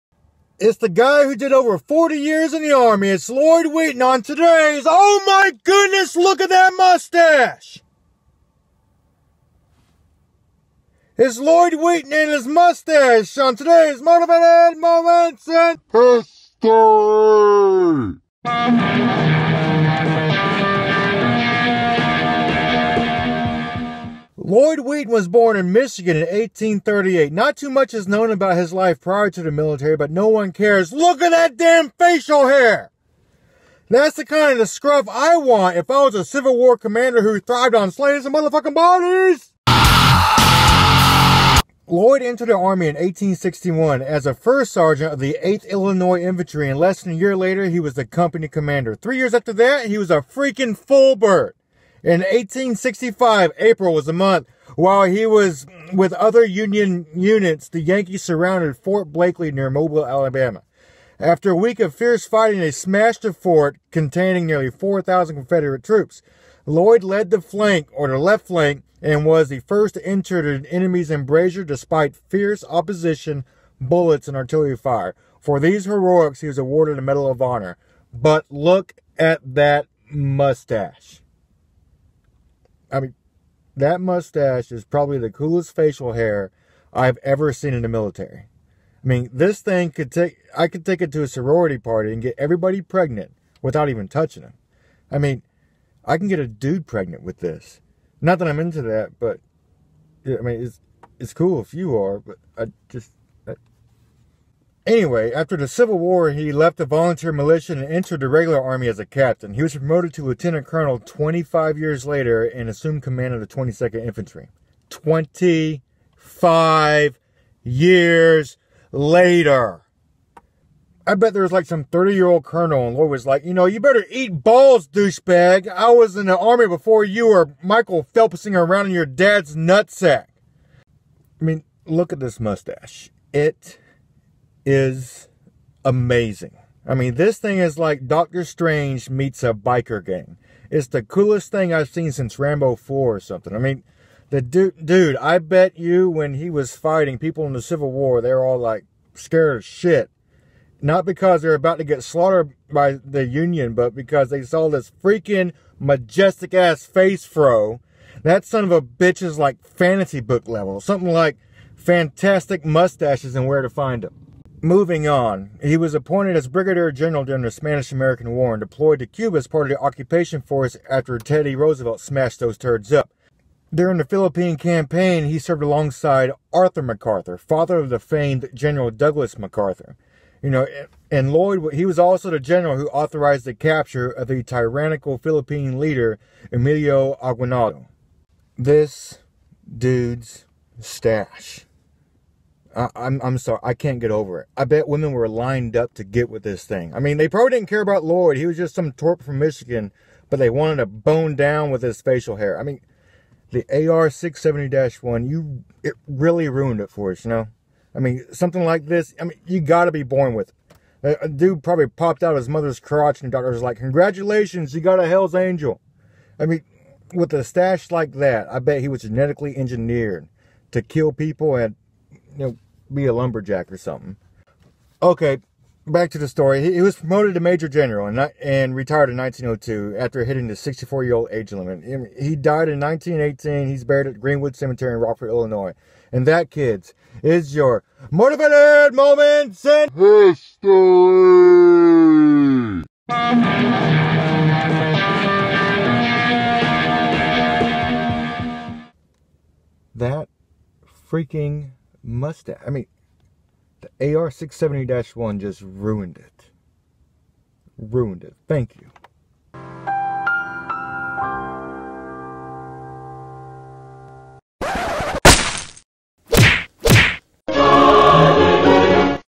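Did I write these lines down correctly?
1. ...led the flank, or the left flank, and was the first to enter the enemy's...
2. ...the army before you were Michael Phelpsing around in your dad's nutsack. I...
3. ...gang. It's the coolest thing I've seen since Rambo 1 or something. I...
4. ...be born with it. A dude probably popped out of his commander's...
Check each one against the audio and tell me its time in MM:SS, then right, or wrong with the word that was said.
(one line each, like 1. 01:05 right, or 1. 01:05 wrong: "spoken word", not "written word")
1. 01:07 right
2. 02:06 right
3. 02:20 wrong: "4", not "1"
4. 03:29 wrong: "mother", not "commander".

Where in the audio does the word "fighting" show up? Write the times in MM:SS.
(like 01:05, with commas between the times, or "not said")
01:02, 02:26.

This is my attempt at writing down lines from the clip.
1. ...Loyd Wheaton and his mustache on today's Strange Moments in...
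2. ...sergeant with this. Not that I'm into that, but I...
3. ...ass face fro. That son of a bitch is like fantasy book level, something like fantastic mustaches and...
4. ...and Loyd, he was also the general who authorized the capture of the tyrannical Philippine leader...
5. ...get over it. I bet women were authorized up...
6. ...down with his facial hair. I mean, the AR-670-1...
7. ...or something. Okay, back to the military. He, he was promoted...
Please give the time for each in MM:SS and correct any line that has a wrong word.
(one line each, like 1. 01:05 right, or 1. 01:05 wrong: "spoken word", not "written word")
1. 00:11 wrong: "Motivated", not "Strange"
2. 01:36 wrong: "pregnant", not "sergeant"
3. 02:36 right
4. 03:01 right
5. 03:13 wrong: "lined", not "authorized"
6. 03:21 right
7. 03:43 wrong: "story", not "military".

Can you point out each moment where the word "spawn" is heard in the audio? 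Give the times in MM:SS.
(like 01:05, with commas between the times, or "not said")
not said.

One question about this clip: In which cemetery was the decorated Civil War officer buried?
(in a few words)
Greenwood Cemetery.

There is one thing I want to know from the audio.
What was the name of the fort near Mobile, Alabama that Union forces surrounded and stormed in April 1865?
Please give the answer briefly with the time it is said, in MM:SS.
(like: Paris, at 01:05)
Fort Blakely, at 00:58.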